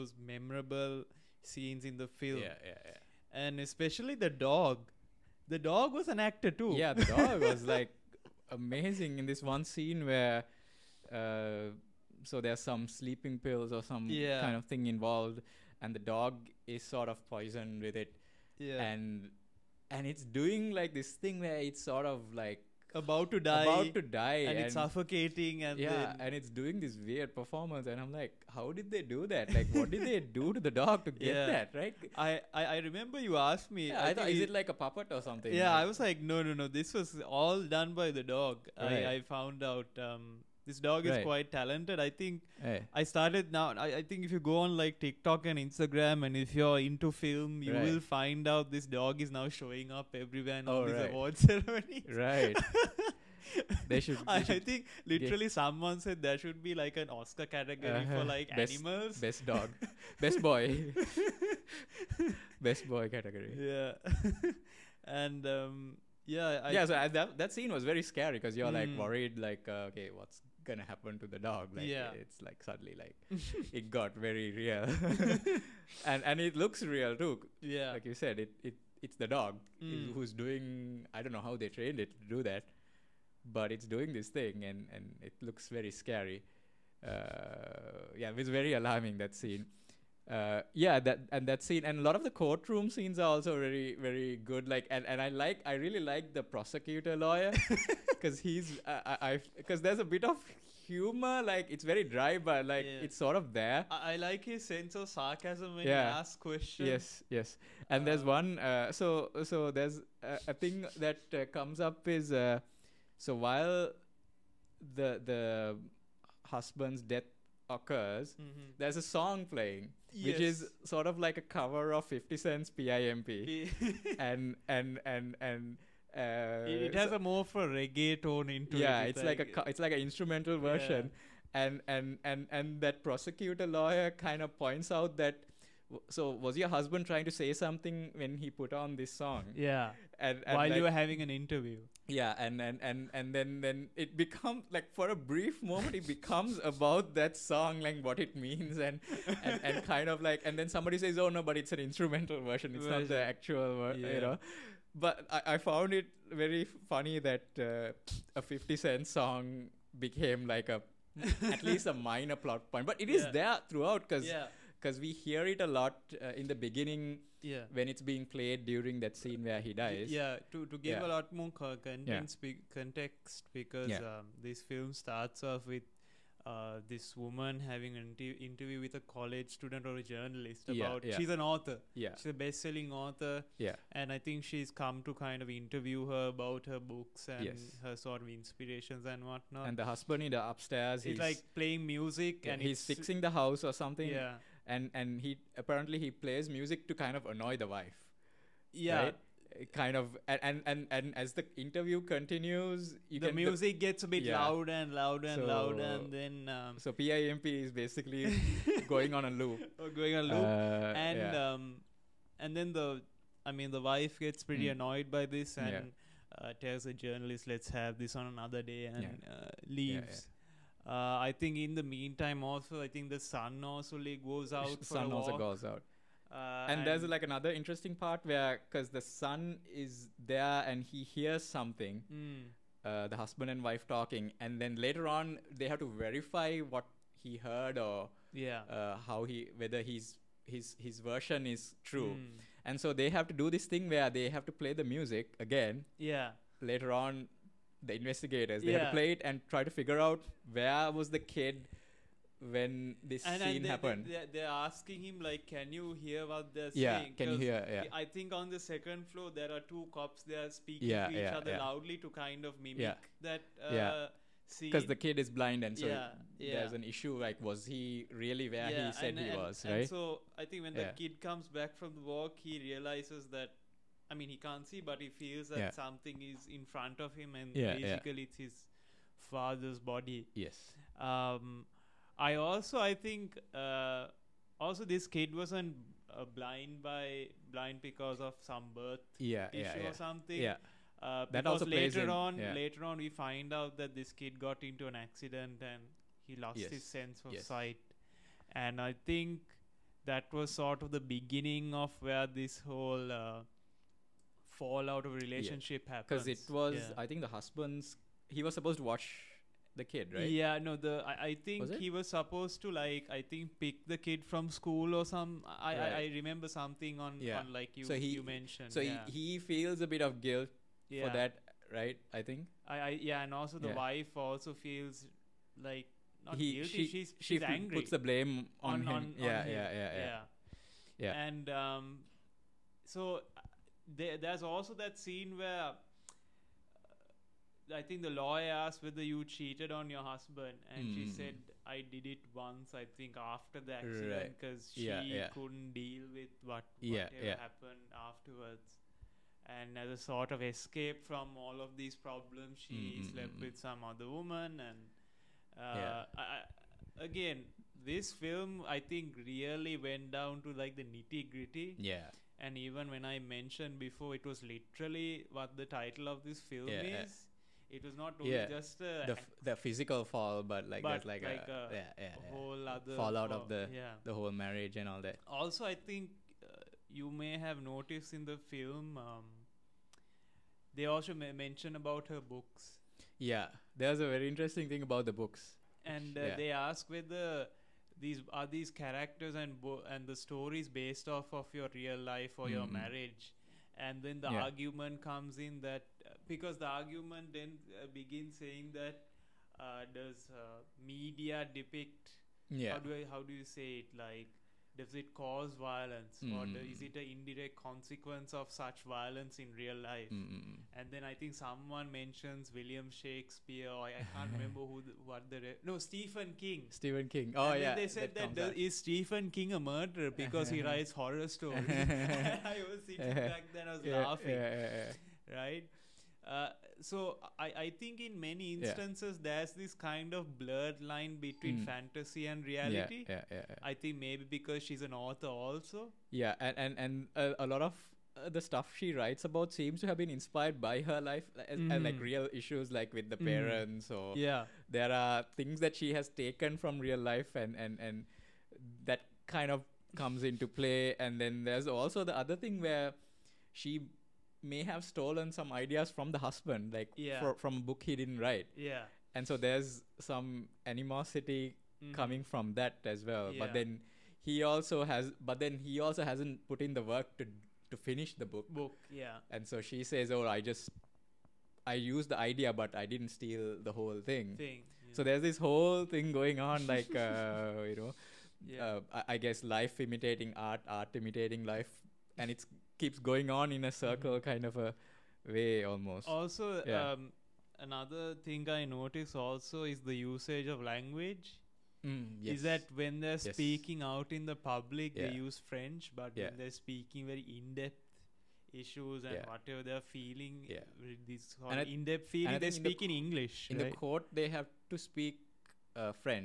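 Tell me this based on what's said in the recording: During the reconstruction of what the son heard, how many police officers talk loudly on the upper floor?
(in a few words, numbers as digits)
2.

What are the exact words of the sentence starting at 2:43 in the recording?
there throughout because yeah because we hear it a lot uh, in the beginning yeah.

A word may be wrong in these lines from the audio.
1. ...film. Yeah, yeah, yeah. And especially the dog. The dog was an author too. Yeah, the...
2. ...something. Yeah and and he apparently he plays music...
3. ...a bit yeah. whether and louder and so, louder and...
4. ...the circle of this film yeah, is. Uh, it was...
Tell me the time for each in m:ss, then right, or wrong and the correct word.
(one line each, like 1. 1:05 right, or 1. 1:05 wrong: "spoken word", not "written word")
1. 0:02 wrong: "actor", not "author"
2. 3:13 right
3. 3:24 wrong: "louder", not "whether"
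4. 6:05 wrong: "title", not "circle".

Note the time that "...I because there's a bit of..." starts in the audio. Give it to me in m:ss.
1:39.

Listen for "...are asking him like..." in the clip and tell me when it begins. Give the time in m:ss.
4:14.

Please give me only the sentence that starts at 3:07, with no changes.
her sort of inspirations and whatnot.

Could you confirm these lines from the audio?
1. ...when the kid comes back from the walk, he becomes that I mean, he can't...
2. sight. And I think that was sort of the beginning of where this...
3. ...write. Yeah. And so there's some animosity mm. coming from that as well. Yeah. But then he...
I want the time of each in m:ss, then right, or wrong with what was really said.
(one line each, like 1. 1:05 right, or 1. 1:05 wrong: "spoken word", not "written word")
1. 4:30 wrong: "realizes", not "becomes"
2. 4:57 right
3. 7:38 right.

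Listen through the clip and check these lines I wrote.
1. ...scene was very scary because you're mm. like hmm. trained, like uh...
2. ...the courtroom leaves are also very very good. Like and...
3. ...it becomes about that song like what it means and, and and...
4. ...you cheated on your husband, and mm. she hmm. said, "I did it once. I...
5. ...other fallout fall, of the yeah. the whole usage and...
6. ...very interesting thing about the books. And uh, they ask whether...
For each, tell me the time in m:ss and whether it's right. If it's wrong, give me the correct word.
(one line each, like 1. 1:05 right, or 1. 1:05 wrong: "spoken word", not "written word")
1. 1:07 wrong: "worried", not "trained"
2. 1:32 wrong: "scenes", not "leaves"
3. 2:25 right
4. 5:39 right
5. 6:12 wrong: "marriage", not "usage"
6. 6:24 right.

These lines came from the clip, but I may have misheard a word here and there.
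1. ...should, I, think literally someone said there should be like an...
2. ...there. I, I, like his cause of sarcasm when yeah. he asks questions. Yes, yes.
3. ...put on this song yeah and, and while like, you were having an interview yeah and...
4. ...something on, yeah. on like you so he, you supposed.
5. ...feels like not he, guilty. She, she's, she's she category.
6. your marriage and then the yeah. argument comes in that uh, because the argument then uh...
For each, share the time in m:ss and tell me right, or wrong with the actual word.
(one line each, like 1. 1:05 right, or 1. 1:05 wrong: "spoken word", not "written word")
1. 0:54 right
2. 1:43 wrong: "sense", not "cause"
3. 2:18 right
4. 5:16 wrong: "mentioned", not "supposed"
5. 5:24 wrong: "angry", not "category"
6. 6:32 right.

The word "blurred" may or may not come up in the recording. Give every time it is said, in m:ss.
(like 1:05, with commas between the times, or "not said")
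7:10.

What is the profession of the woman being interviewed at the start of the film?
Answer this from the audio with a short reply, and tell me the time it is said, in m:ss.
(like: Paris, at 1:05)
Best-selling author, at 3:02.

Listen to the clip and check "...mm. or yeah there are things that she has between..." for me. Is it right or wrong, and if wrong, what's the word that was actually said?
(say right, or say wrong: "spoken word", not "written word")
wrong: "taken", not "between".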